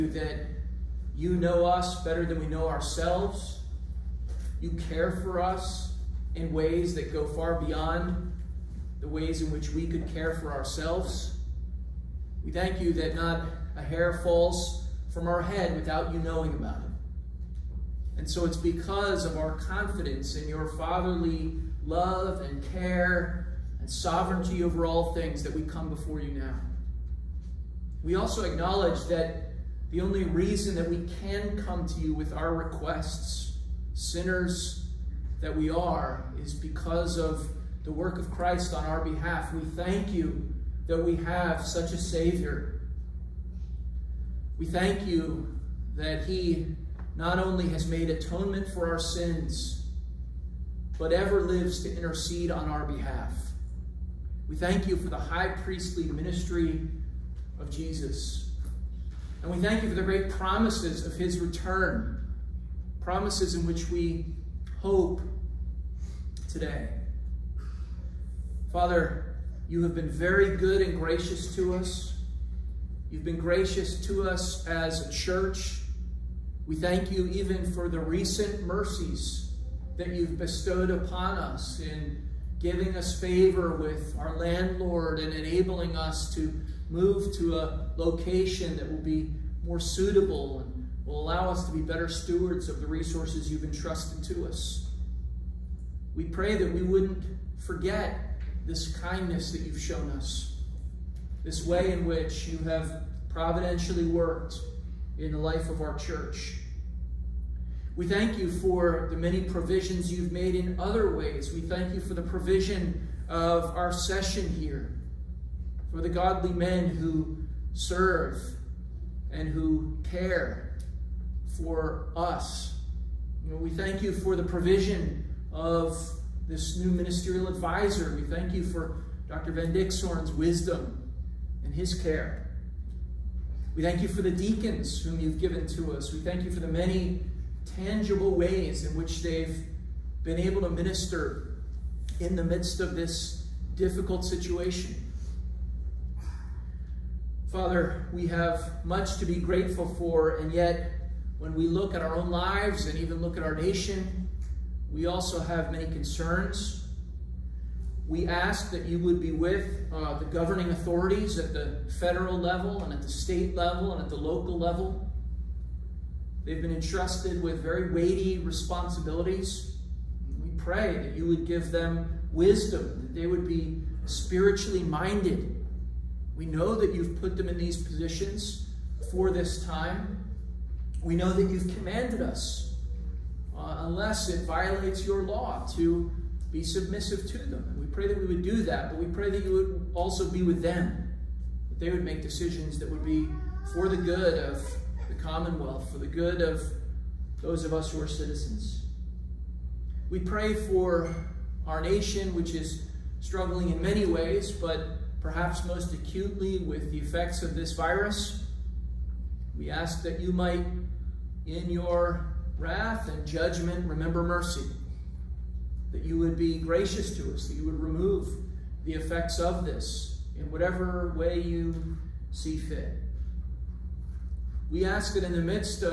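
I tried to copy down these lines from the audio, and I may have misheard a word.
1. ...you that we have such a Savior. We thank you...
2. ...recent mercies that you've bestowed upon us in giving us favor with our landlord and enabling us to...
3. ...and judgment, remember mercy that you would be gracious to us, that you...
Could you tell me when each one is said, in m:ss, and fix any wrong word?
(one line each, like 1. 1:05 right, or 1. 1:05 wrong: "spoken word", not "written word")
1. 0:40 right
2. 1:17 right
3. 3:33 right.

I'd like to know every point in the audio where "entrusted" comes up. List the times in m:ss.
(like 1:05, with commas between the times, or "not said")
1:33, 2:46.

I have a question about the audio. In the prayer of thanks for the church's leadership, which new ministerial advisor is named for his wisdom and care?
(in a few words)
Dr. Van Dixhoorn.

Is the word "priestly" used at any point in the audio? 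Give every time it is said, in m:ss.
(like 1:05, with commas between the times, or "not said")
0:55.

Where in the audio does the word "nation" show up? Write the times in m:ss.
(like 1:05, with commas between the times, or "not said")
2:33, 3:21.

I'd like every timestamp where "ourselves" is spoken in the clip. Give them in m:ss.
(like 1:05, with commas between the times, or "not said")
0:02, 0:10.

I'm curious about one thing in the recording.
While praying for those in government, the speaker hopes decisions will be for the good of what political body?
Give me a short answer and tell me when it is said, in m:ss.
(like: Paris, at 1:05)
the Commonwealth, at 3:15.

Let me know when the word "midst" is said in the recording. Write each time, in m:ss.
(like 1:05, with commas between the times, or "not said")
2:22, 3:45.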